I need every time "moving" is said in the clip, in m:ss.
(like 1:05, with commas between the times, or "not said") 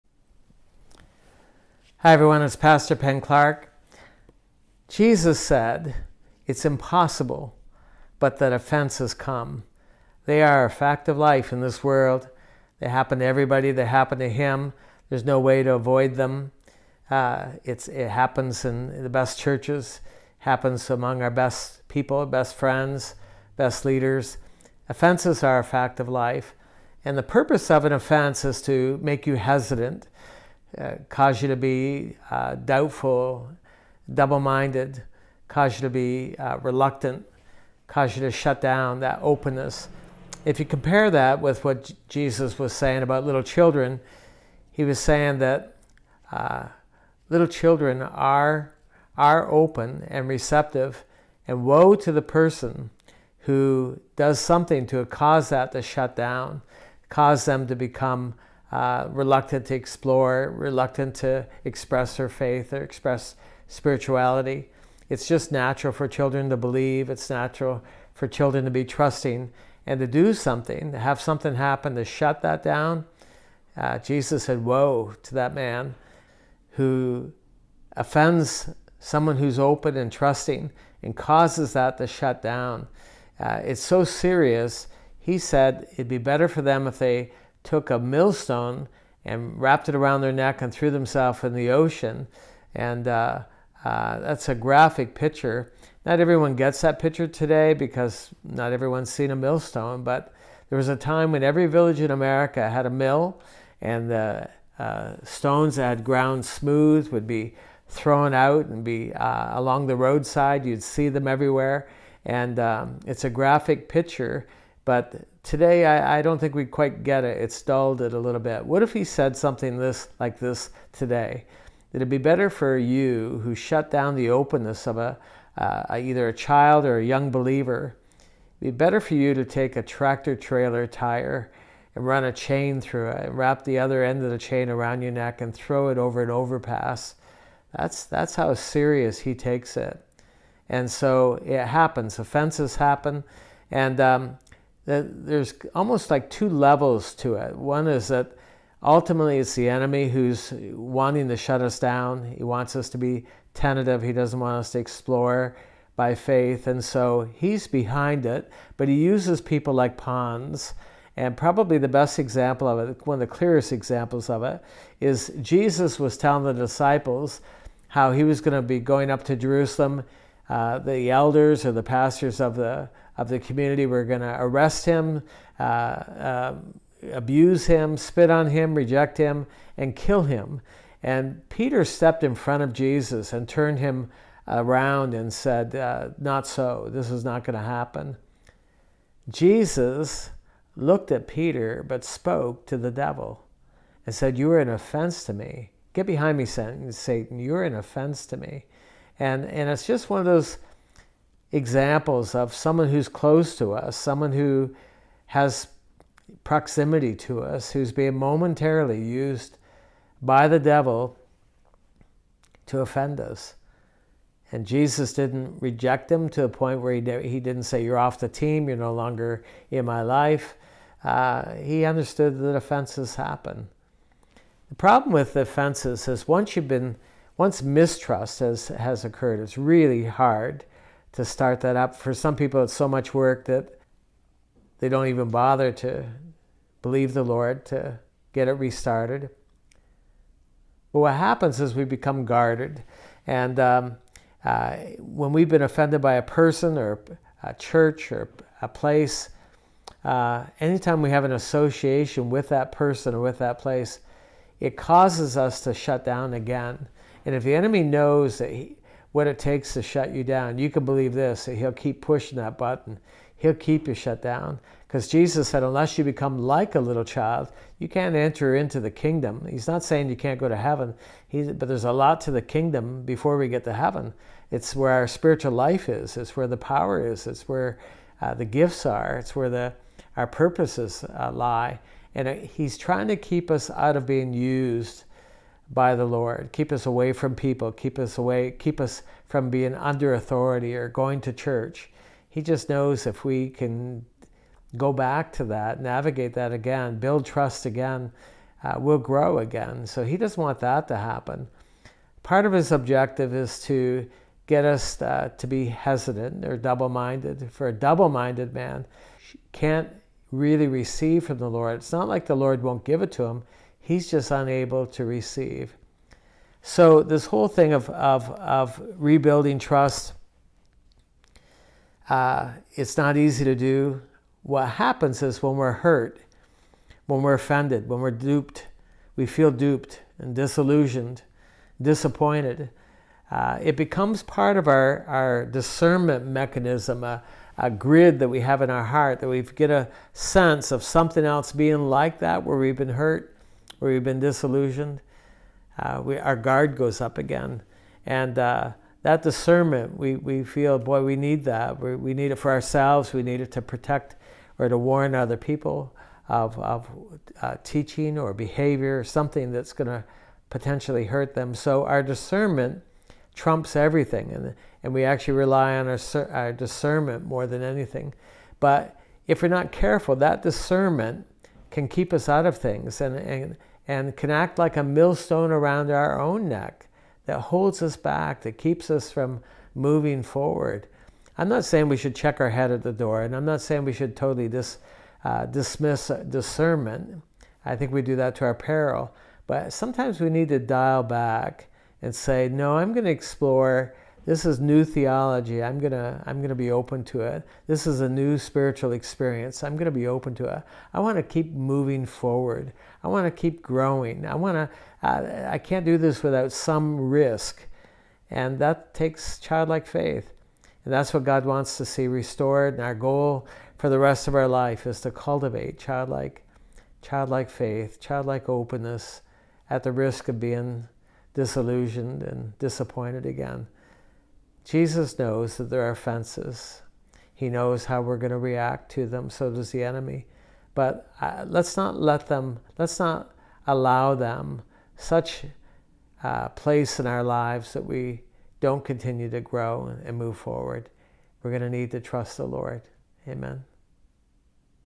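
6:19, 6:41.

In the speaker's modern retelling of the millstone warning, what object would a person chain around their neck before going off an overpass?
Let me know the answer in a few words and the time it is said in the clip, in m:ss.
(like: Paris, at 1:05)
tractor trailer tire, at 2:09.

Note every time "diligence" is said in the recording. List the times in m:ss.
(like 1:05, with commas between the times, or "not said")
not said.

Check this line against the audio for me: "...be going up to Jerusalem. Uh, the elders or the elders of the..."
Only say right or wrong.
wrong.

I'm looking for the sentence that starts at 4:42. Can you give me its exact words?
And uh, he's trying to keep us out of being used by the Lord.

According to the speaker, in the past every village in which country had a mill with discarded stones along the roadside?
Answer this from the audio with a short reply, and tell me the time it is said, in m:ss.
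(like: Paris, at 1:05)
America, at 1:42.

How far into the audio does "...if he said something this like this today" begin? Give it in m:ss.
1:58.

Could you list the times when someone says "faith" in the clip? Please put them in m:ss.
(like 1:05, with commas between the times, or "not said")
1:02, 2:36, 6:49, 6:57.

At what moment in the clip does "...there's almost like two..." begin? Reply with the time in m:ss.
2:24.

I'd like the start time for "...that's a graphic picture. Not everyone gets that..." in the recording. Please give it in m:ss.
1:34.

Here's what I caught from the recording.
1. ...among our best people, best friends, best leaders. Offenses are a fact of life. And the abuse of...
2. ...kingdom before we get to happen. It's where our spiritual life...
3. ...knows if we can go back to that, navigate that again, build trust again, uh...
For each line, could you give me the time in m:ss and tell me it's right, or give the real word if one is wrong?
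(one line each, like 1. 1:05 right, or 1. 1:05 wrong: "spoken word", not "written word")
1. 0:20 wrong: "purpose", not "abuse"
2. 4:32 wrong: "heaven", not "happen"
3. 4:52 right.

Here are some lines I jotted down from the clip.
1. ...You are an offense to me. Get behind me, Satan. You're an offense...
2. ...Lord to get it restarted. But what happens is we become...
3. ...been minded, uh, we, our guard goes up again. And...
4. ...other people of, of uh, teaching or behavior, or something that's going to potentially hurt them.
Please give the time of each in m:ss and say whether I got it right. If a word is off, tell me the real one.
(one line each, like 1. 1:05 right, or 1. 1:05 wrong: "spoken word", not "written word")
1. 3:14 right
2. 3:57 right
3. 5:44 wrong: "disillusioned", not "minded"
4. 5:55 right.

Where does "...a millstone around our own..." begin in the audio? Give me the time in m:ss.
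6:14.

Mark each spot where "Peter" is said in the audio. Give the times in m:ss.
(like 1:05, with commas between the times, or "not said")
3:01, 3:11.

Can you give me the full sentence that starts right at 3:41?
Uh, he understood that offenses happen.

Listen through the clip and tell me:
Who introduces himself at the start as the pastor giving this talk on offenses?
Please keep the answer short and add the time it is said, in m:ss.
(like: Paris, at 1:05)
Penn Clark, at 0:02.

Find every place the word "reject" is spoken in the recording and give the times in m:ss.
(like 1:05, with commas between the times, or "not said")
2:58, 3:35.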